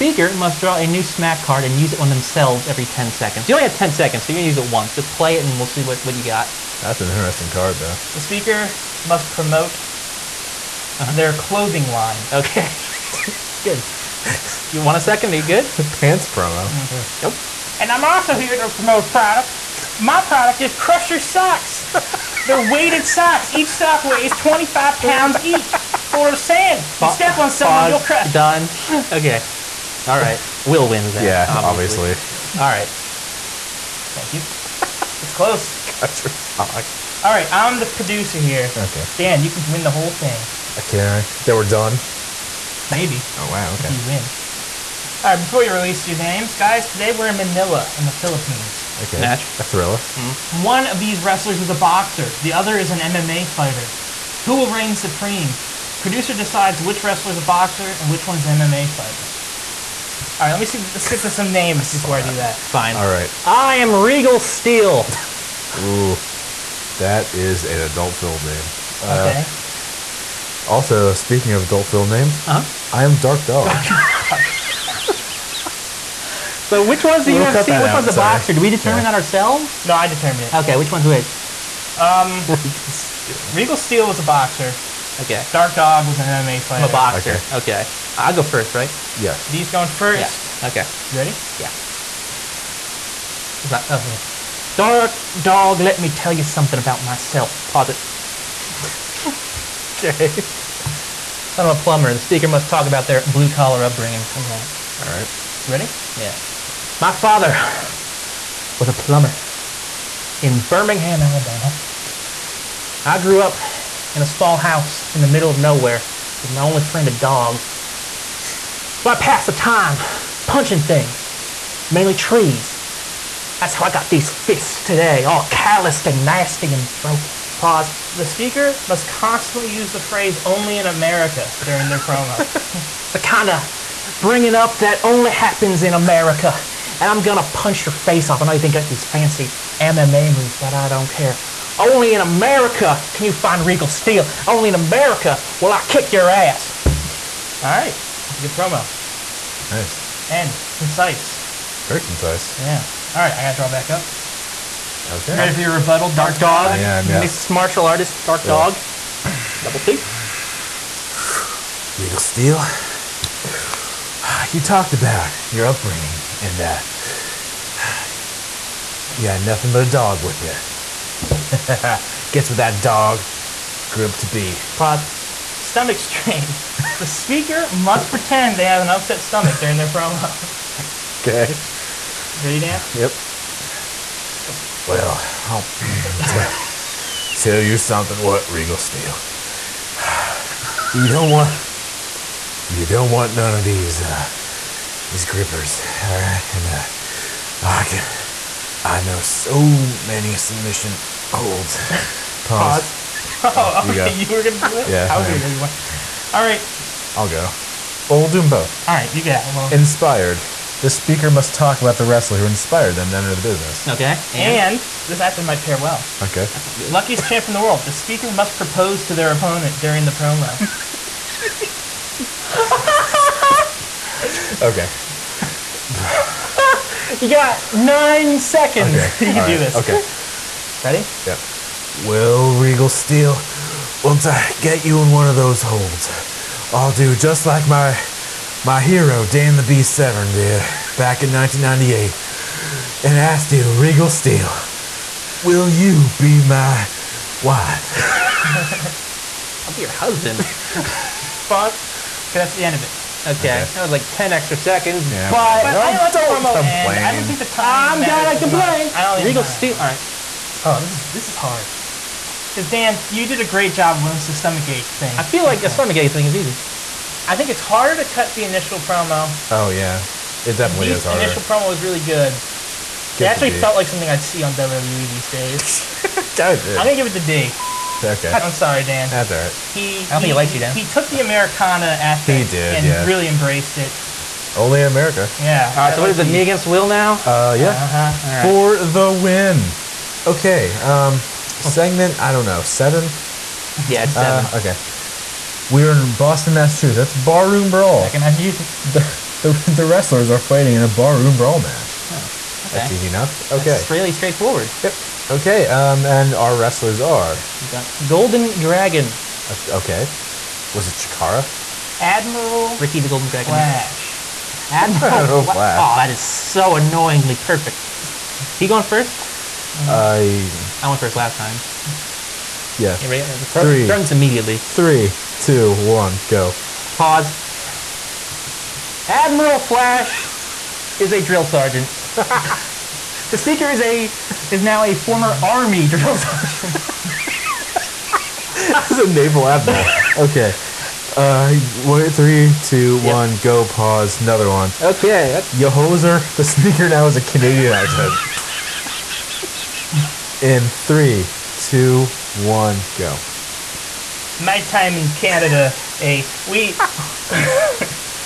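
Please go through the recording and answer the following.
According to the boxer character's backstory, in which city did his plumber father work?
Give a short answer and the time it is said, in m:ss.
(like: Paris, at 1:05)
Birmingham, Alabama, at 1:50.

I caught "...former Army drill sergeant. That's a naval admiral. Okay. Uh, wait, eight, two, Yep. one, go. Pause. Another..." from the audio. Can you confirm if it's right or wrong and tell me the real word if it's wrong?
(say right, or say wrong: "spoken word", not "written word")
wrong: "three", not "eight".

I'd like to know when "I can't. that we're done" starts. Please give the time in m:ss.
0:40.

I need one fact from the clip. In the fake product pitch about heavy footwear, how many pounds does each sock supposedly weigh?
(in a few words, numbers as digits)
25.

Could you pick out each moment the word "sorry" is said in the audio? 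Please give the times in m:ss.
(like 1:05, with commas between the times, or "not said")
1:18, 4:38.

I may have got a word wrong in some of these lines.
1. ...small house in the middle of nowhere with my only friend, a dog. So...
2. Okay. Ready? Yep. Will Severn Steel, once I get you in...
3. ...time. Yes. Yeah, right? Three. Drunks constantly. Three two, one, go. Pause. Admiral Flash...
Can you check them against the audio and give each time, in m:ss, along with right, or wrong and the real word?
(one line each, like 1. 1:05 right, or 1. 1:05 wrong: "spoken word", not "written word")
1. 1:54 right
2. 3:49 wrong: "Regal", not "Severn"
3. 5:21 wrong: "immediately", not "constantly".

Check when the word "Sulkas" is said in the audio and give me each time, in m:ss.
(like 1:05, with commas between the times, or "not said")
not said.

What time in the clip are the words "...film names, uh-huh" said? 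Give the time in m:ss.
1:11.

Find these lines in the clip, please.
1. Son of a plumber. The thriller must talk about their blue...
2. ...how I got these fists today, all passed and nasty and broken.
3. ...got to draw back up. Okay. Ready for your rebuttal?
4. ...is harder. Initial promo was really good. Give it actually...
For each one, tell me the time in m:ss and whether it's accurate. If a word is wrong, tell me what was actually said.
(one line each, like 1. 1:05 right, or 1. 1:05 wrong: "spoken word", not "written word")
1. 1:41 wrong: "speaker", not "thriller"
2. 2:03 wrong: "calloused", not "passed"
3. 2:33 right
4. 4:30 right.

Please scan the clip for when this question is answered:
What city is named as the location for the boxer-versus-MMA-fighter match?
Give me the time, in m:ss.
0:47.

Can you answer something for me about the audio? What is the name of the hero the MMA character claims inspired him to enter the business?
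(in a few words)
Dan the Beast Severn.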